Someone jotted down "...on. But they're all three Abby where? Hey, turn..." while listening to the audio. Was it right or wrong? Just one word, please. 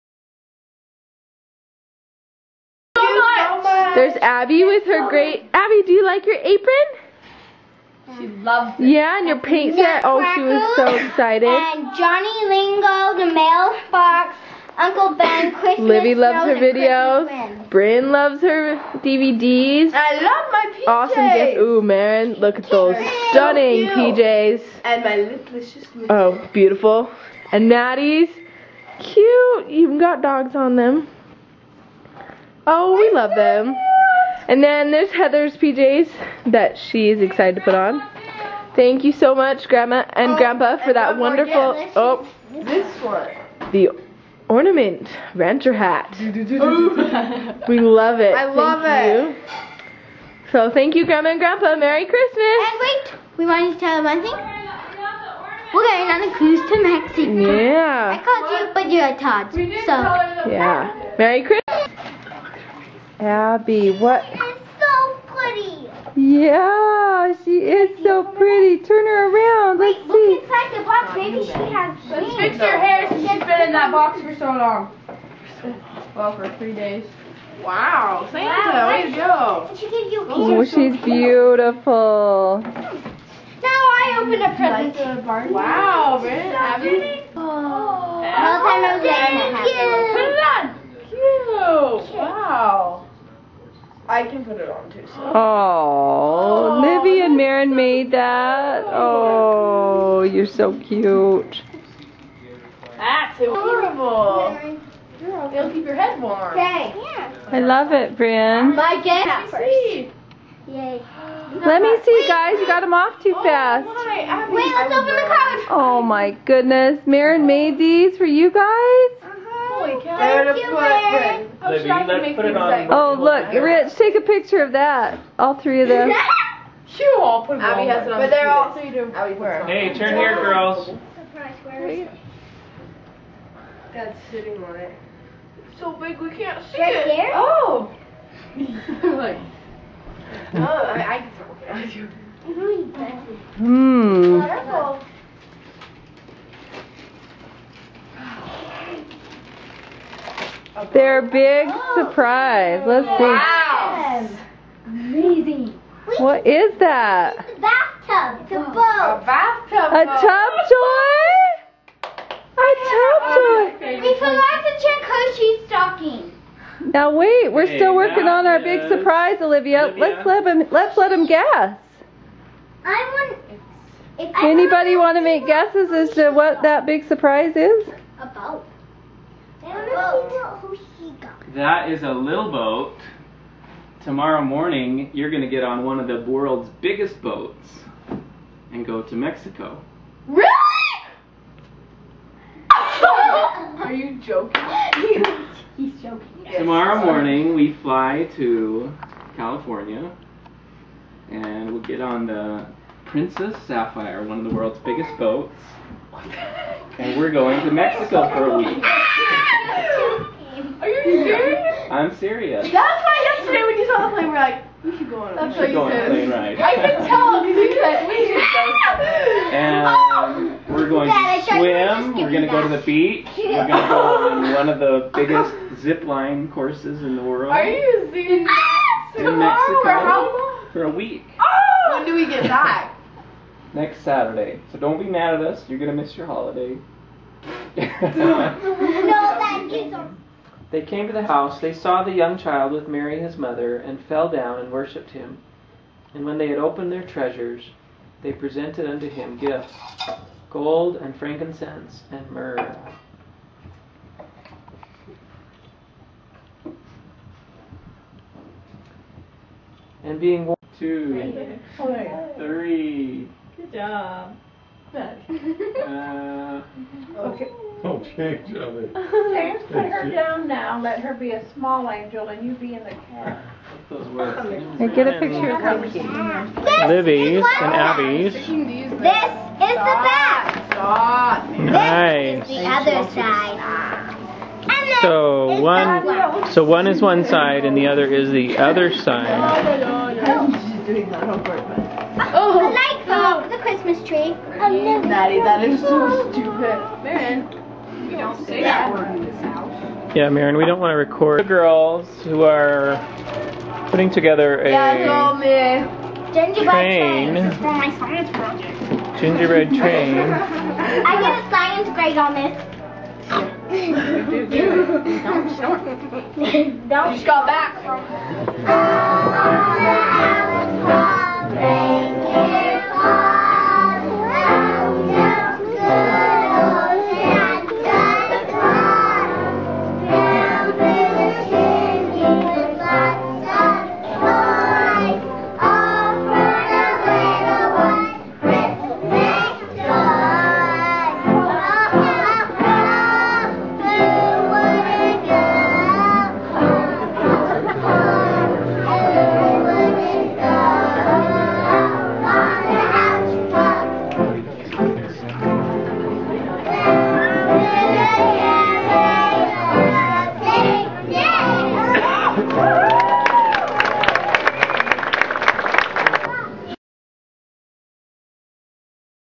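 right.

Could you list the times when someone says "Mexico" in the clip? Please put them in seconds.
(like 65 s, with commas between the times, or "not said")
56 s, 189 s, 207 s, 230 s.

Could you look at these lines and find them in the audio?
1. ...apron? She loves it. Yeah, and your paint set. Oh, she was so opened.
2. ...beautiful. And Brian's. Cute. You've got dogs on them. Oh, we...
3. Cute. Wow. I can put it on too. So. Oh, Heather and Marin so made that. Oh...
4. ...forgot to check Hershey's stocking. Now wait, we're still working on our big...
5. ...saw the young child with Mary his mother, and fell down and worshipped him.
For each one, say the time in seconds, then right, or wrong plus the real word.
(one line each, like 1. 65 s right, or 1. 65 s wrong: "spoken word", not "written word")
1. 6 s wrong: "excited", not "opened"
2. 26 s wrong: "Natty", not "Brian"
3. 91 s wrong: "Livy", not "Heather"
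4. 164 s right
5. 241 s right.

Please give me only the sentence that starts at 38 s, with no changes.
Thank you so much, Grandma and Grandpa, oh, for that wonderful.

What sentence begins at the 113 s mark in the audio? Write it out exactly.
My, Wait, let's open the cover.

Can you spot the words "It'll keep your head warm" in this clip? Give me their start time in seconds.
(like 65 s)
105 s.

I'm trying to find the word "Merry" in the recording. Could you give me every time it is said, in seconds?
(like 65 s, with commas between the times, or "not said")
51 s, 61 s.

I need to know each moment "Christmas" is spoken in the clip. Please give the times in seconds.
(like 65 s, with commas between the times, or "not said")
15 s, 52 s, 61 s, 293 s.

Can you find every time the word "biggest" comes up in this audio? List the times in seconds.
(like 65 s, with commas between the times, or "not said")
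186 s, 204 s, 225 s.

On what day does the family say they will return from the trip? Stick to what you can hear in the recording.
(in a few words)
Next Saturday.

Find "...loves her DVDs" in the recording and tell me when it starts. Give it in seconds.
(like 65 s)
18 s.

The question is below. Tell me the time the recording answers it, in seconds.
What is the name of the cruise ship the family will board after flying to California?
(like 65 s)
203 s.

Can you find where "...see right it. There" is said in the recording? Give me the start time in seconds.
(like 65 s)
136 s.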